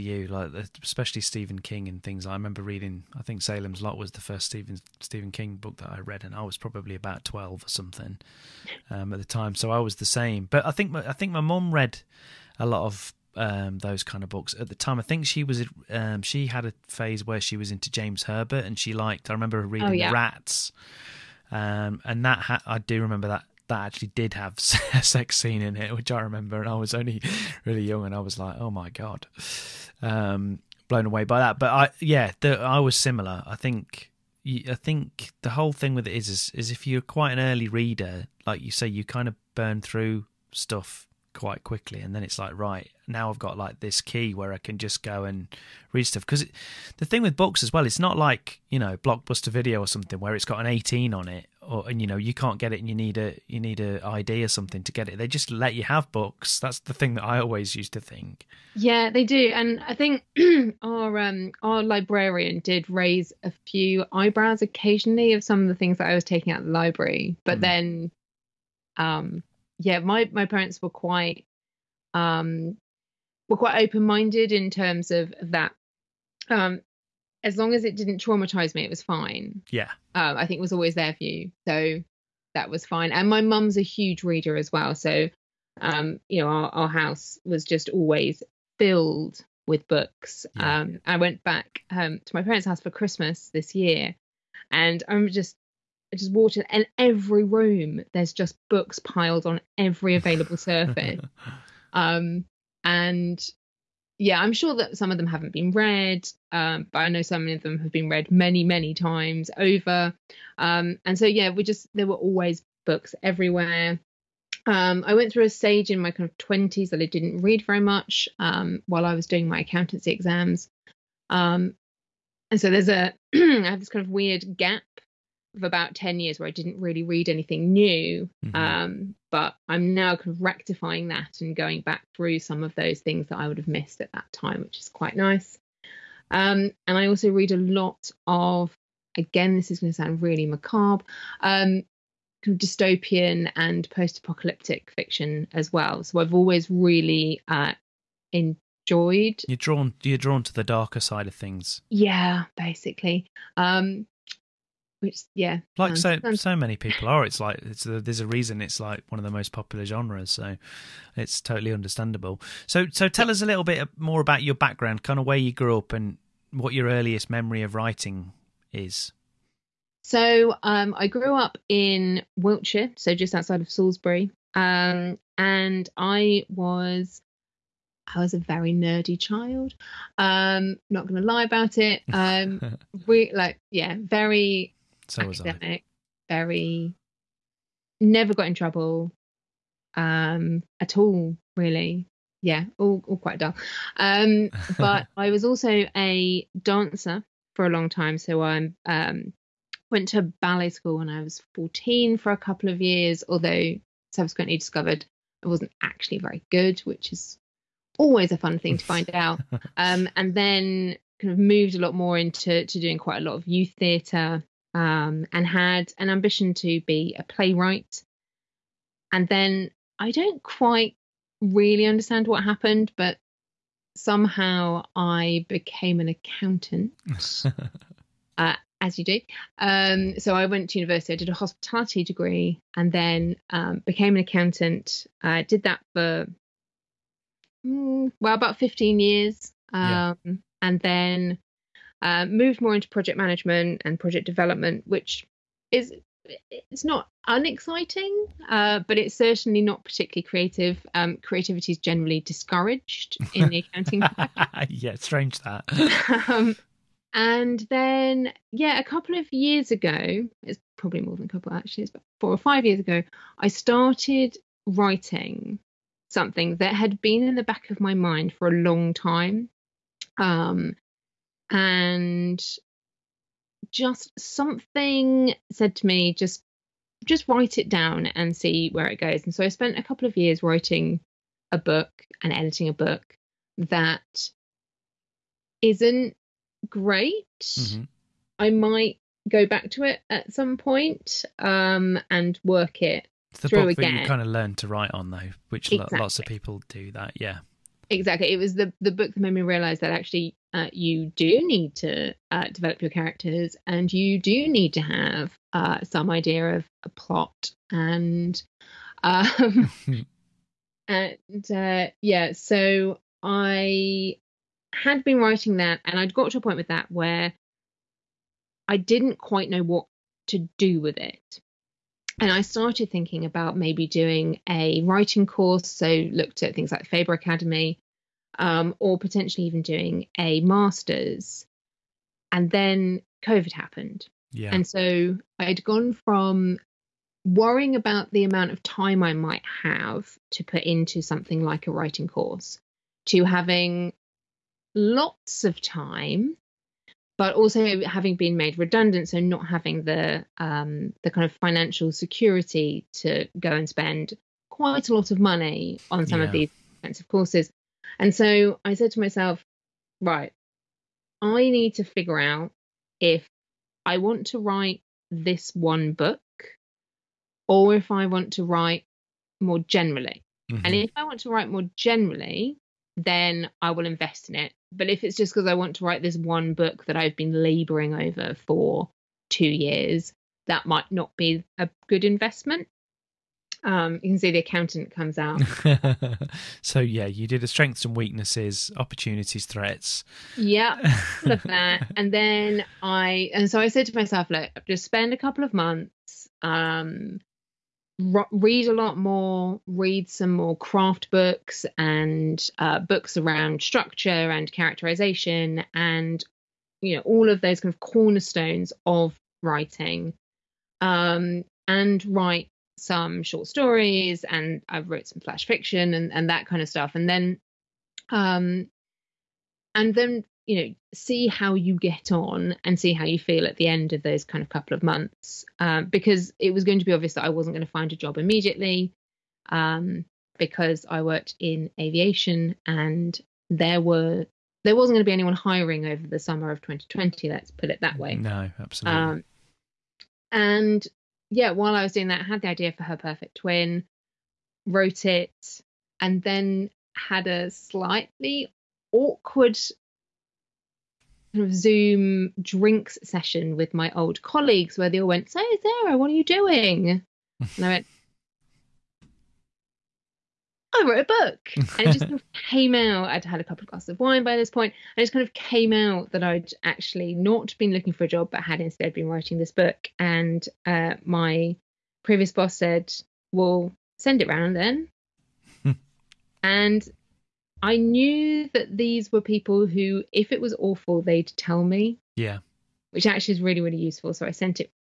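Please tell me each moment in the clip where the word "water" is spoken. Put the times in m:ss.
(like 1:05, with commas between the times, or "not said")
1:36.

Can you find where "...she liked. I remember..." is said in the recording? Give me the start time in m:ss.
0:18.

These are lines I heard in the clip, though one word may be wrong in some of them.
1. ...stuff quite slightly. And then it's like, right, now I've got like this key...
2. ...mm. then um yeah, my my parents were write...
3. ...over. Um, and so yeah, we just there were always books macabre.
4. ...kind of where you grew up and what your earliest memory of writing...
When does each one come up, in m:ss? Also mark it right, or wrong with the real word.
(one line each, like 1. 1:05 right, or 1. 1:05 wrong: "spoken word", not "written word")
1. 0:40 wrong: "quickly", not "slightly"
2. 1:07 wrong: "quite", not "write"
3. 1:49 wrong: "everywhere", not "macabre"
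4. 2:45 right.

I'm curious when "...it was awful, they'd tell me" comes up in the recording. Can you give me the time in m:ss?
8:00.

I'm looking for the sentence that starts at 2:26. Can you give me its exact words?
So I've always really uh, in Enjoyed.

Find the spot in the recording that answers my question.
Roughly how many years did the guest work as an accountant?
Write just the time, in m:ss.
3:58.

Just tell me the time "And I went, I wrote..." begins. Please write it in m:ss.
7:37.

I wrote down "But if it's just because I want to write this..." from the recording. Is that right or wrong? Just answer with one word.
right.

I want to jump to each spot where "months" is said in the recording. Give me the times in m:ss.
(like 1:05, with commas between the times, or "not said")
6:35, 7:04.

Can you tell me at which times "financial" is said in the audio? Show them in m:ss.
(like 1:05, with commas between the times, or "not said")
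5:51.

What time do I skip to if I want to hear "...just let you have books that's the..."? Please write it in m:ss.
0:55.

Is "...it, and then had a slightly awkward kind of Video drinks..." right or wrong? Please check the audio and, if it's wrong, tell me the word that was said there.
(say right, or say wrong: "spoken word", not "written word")
wrong: "Zoom", not "Video".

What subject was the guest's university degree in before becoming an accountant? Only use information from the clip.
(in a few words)
Hospitality.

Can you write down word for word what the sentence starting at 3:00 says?
Um, not going to lie about it.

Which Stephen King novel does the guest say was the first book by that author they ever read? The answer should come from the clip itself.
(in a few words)
Salem's Lot.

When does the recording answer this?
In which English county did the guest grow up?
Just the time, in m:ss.
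2:52.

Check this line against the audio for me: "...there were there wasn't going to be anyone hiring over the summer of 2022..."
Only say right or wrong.
wrong.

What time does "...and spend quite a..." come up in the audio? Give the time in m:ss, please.
5:53.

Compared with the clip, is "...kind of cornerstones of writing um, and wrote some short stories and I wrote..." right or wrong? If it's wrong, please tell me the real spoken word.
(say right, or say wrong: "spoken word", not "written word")
wrong: "write", not "wrote".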